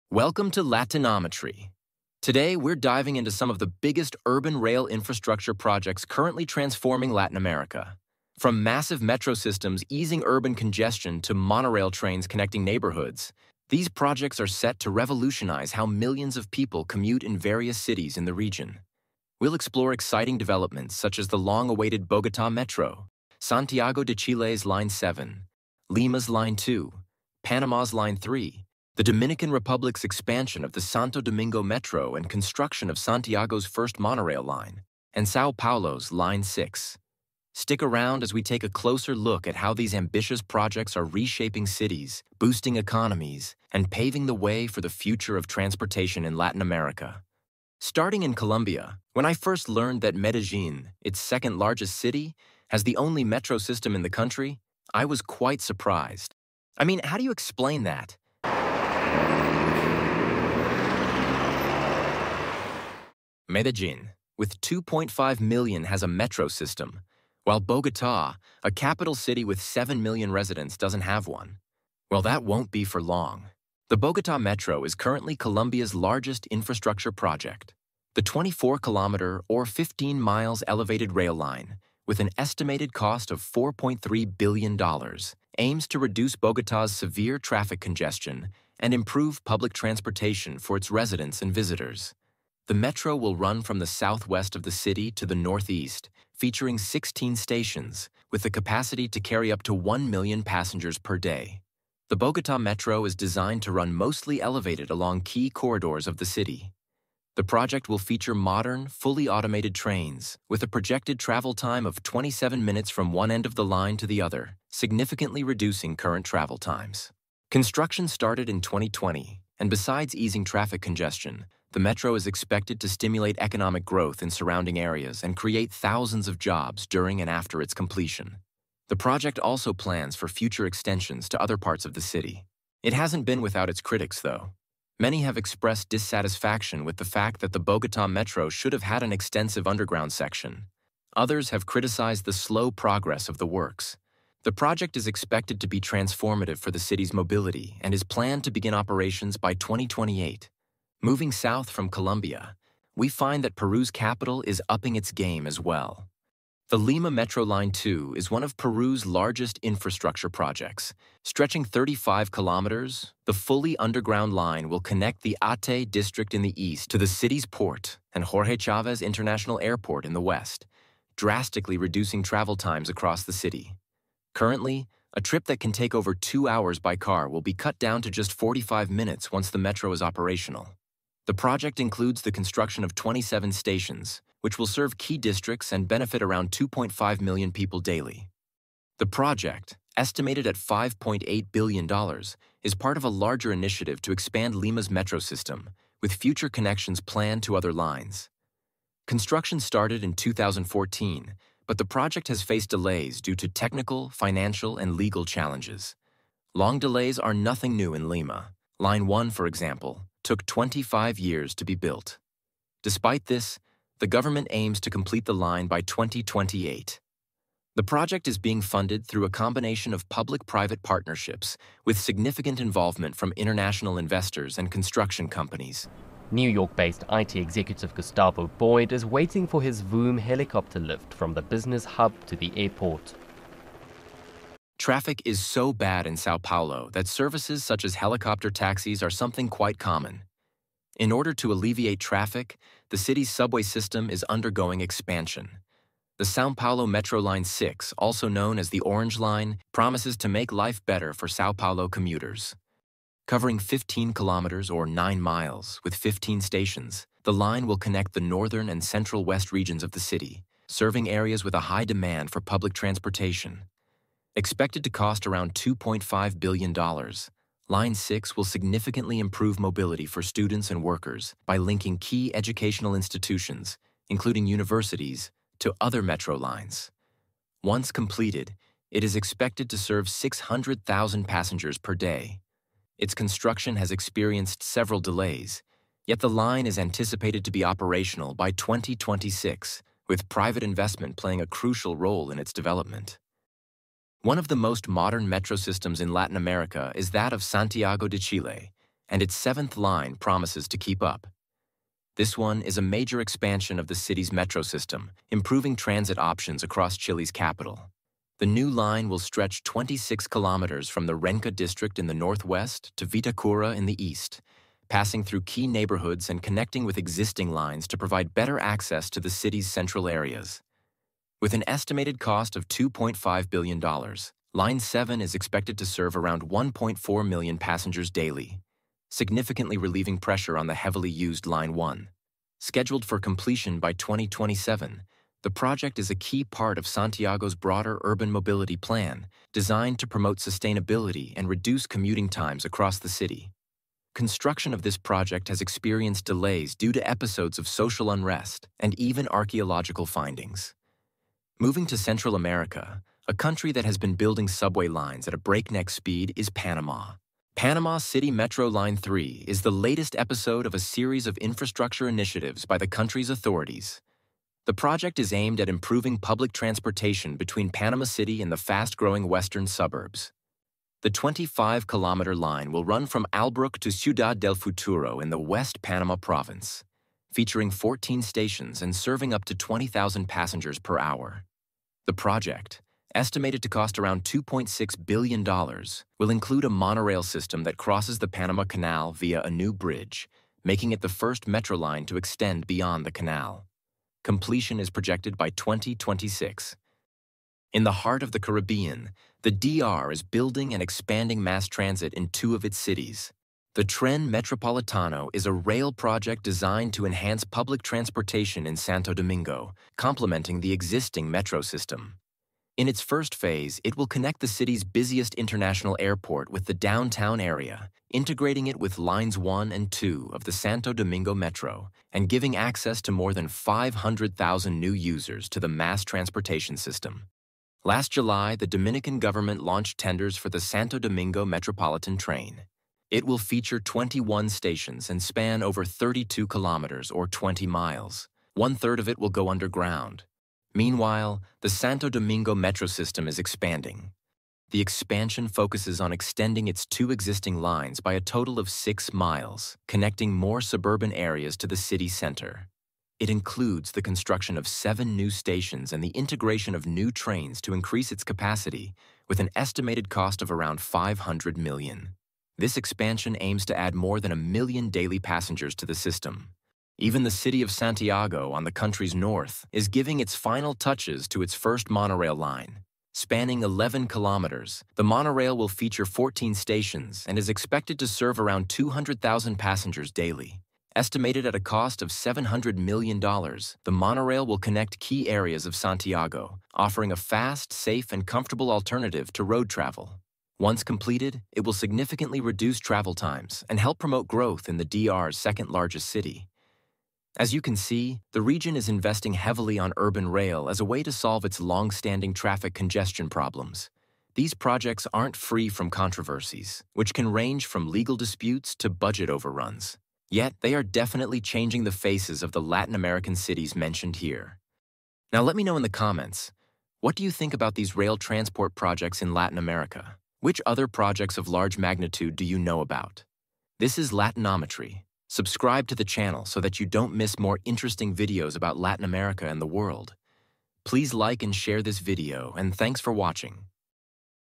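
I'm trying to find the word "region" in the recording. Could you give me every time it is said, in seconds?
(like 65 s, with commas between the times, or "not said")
18 s, 259 s, 498 s.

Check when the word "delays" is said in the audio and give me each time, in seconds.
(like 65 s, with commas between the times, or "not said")
202 s, 206 s, 285 s, 346 s.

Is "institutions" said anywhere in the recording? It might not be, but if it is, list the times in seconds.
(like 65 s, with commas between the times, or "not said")
272 s.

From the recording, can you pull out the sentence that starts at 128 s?
The project also plans for future extensions to other parts of the city.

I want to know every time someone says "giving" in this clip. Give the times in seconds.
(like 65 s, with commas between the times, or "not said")
422 s, 469 s.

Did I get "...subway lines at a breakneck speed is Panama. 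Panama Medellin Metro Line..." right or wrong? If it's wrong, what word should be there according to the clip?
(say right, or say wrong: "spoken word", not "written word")
wrong: "City", not "Medellin".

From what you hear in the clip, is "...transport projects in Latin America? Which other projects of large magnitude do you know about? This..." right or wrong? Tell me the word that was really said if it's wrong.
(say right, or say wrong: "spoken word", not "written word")
right.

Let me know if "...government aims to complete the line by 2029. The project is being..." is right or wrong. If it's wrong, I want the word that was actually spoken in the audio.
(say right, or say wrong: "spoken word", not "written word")
wrong: "2028", not "2029".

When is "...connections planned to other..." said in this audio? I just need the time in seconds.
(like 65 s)
196 s.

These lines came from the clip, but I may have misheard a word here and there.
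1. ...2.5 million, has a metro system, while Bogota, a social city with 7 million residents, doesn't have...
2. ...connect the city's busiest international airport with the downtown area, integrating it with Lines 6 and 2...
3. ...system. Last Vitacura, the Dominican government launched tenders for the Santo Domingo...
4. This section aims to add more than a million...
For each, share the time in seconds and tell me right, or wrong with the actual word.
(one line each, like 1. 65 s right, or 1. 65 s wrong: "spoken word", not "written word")
1. 64 s wrong: "capital", not "social"
2. 414 s wrong: "1", not "6"
3. 426 s wrong: "July", not "Vitacura"
4. 462 s wrong: "expansion", not "section".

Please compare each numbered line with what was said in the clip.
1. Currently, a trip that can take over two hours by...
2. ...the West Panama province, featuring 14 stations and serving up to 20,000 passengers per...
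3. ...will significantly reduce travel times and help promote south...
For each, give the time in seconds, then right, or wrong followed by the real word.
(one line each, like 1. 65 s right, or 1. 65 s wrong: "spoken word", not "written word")
1. 174 s right
2. 375 s right
3. 491 s wrong: "growth", not "south".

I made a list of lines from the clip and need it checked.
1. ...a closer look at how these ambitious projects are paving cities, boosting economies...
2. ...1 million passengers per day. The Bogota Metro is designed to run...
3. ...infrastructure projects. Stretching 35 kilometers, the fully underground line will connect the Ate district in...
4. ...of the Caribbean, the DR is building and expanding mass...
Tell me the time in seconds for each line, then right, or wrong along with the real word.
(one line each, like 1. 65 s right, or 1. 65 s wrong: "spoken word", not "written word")
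1. 38 s wrong: "reshaping", not "paving"
2. 99 s right
3. 159 s right
4. 398 s right.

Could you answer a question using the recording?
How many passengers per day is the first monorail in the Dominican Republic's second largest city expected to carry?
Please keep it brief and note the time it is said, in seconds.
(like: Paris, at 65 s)
200,000, at 478 s.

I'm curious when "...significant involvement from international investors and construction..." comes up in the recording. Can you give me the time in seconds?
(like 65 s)
221 s.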